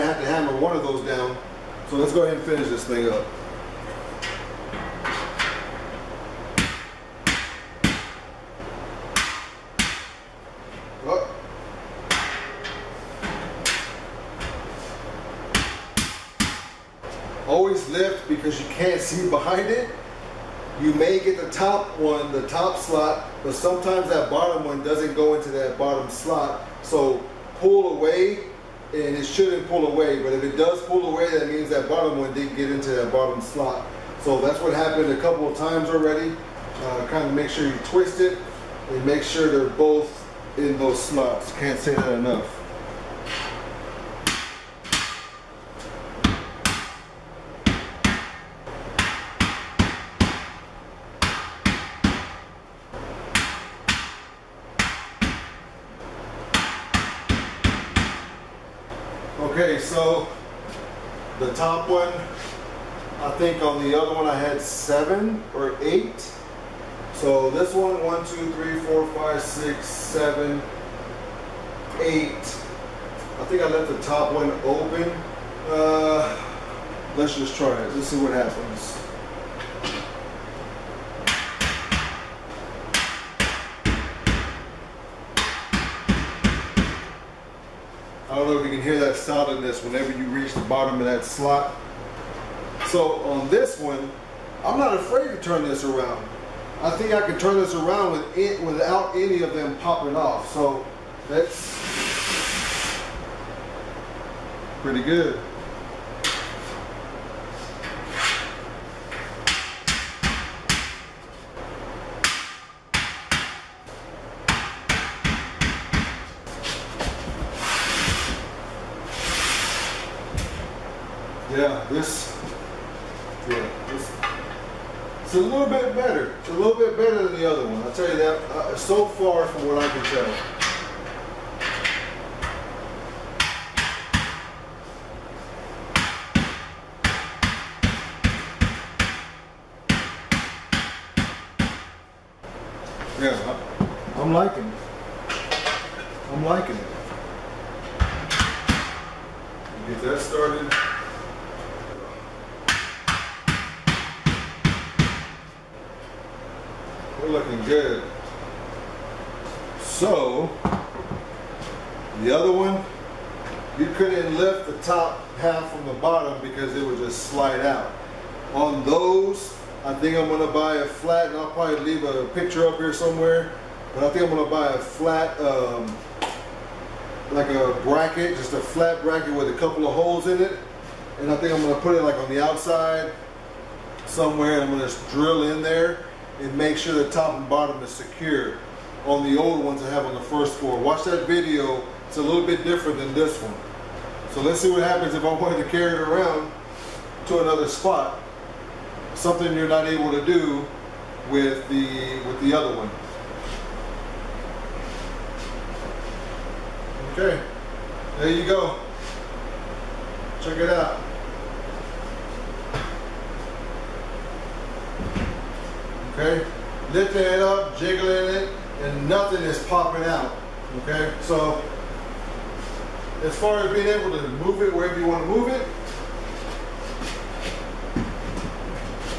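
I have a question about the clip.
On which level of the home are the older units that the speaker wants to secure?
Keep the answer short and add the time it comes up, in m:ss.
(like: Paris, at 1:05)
first floor, at 3:10.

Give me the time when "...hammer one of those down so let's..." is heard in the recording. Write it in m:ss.
0:00.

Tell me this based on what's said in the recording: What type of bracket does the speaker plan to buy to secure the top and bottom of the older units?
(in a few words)
flat bracket.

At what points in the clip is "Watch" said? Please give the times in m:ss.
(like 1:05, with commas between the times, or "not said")
3:10.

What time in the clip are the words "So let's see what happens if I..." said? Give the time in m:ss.
3:14.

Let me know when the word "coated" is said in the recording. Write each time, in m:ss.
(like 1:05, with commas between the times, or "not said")
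not said.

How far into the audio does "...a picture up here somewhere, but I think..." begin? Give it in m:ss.
2:52.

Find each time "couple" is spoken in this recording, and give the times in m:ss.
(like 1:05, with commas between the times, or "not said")
0:35, 2:59.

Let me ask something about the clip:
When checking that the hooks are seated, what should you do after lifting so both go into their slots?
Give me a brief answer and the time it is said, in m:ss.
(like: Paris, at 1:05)
twist it, at 0:37.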